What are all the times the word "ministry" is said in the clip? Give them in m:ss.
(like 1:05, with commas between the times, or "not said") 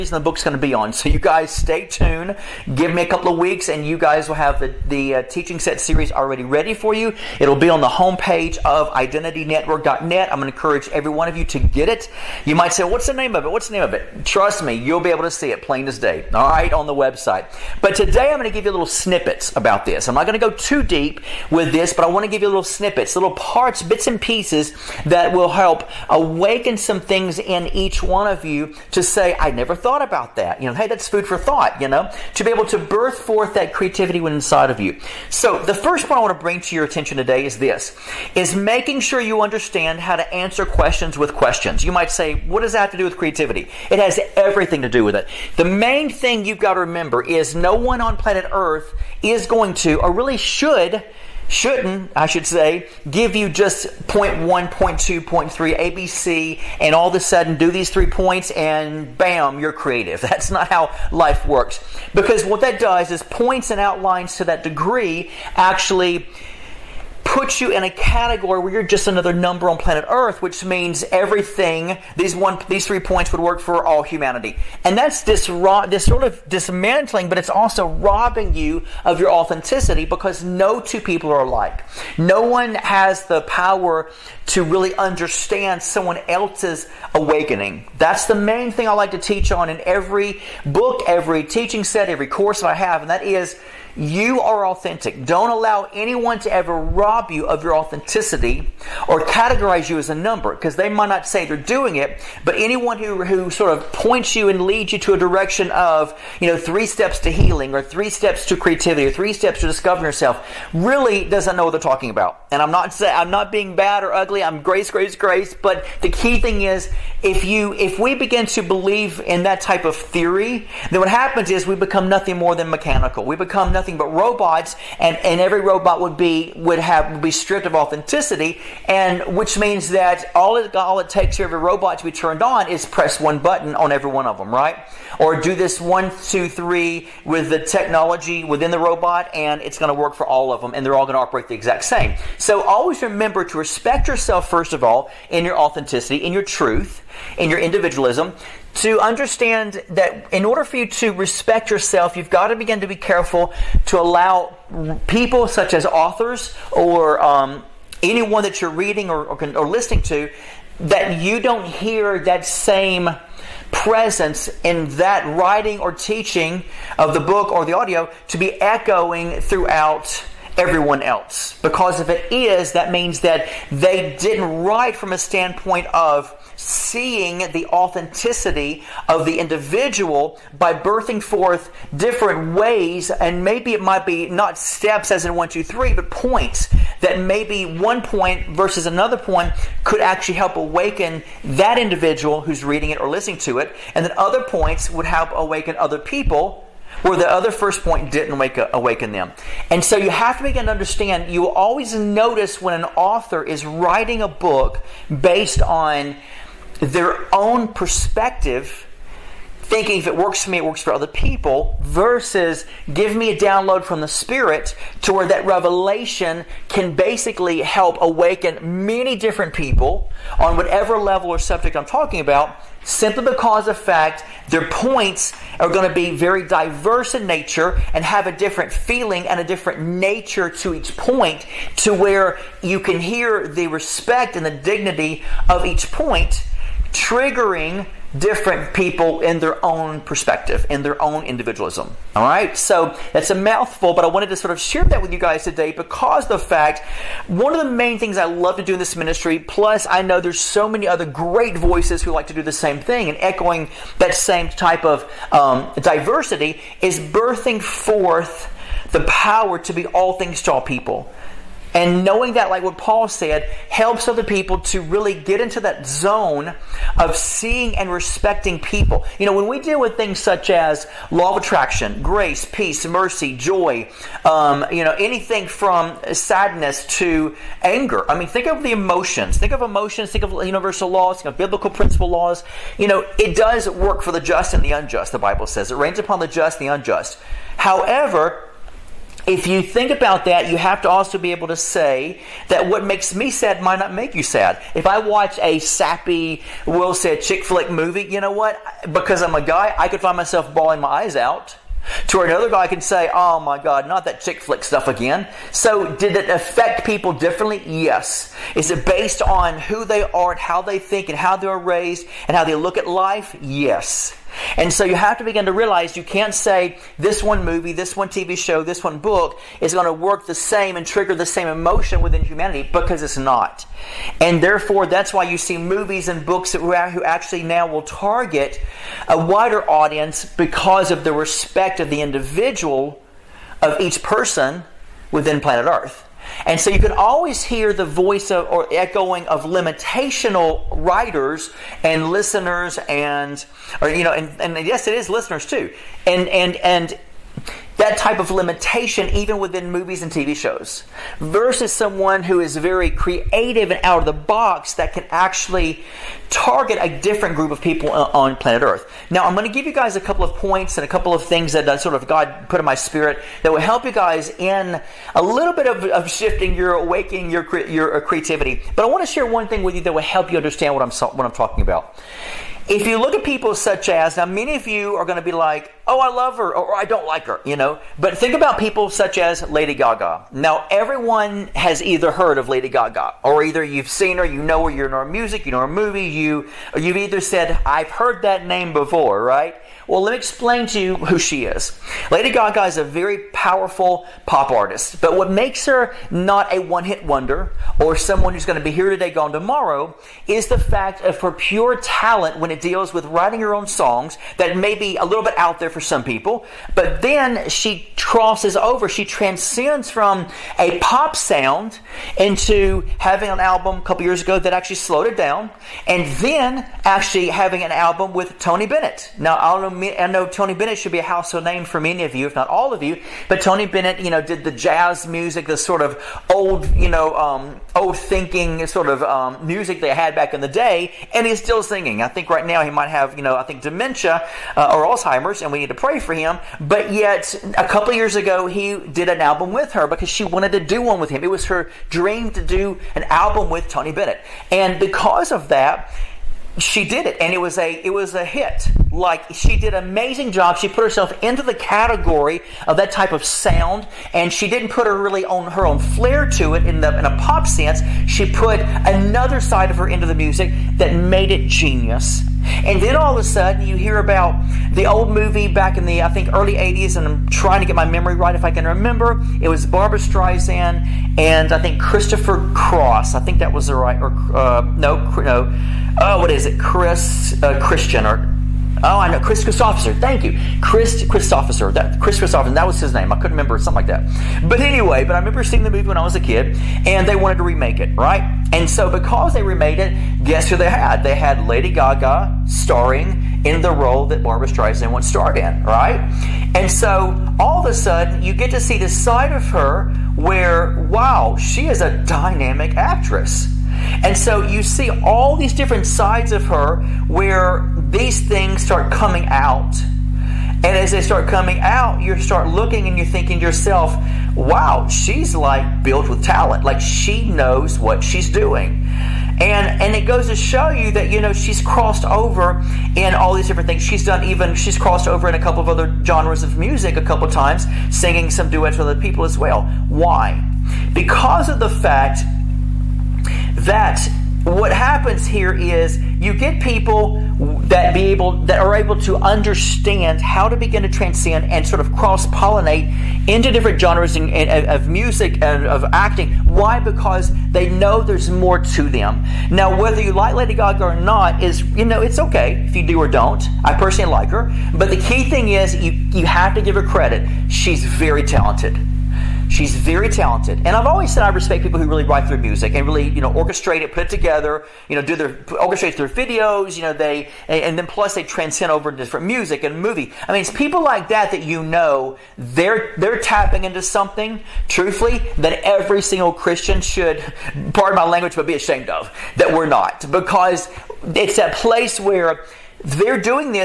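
4:08.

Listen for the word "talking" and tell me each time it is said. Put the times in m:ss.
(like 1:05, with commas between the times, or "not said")
1:51, 3:41, 6:11.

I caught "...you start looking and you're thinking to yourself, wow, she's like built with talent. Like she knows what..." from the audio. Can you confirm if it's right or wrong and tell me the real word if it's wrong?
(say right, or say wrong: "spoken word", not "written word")
right.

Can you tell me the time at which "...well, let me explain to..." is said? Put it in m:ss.
6:29.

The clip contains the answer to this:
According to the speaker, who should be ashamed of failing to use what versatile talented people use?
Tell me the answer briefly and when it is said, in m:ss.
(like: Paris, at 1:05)
every single Christian, at 9:35.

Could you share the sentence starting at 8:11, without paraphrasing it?
They had Lady Gaga starring in the role that Barbra Streisand once starred in, right?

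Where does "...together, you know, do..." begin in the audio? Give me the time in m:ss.
9:24.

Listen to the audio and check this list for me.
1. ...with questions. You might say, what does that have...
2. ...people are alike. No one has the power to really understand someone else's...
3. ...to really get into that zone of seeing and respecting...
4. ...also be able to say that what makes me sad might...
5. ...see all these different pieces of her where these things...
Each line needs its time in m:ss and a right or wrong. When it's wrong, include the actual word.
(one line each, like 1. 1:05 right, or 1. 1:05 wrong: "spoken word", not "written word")
1. 0:41 right
2. 1:20 right
3. 4:24 right
4. 4:50 right
5. 8:24 wrong: "sides", not "pieces".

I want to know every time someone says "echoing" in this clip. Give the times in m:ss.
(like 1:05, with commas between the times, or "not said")
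2:48, 4:13, 5:38.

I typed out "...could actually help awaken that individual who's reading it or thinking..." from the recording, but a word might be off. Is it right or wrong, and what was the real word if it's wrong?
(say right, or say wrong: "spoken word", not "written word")
wrong: "listening", not "thinking".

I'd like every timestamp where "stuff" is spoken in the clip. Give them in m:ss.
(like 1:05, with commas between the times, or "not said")
5:04.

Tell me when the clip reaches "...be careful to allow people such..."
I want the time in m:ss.
2:32.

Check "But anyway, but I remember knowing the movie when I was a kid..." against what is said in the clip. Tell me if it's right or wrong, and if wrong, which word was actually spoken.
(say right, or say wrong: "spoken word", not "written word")
wrong: "seeing", not "knowing".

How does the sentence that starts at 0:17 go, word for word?
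But today I'm going to give you little snippets about this.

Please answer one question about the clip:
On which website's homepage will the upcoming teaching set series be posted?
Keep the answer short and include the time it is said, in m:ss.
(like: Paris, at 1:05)
identitynetwork.net, at 0:08.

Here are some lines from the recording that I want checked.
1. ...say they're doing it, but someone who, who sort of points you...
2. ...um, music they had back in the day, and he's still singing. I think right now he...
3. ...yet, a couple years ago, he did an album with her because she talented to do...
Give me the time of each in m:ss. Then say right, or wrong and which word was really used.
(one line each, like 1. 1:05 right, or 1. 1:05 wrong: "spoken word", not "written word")
1. 1:41 wrong: "anyone", not "someone"
2. 7:09 right
3. 7:16 wrong: "wanted", not "talented".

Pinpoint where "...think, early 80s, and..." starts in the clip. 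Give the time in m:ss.
7:46.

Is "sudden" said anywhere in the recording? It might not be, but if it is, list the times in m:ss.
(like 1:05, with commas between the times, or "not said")
0:57, 7:43, 8:17.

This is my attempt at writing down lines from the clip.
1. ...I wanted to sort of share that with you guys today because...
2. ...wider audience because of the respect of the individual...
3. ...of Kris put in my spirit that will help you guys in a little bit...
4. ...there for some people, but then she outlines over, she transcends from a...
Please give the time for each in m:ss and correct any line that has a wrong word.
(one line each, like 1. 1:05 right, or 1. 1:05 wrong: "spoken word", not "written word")
1. 4:04 right
2. 5:29 right
3. 6:01 wrong: "God", not "Kris"
4. 6:45 wrong: "crosses", not "outlines".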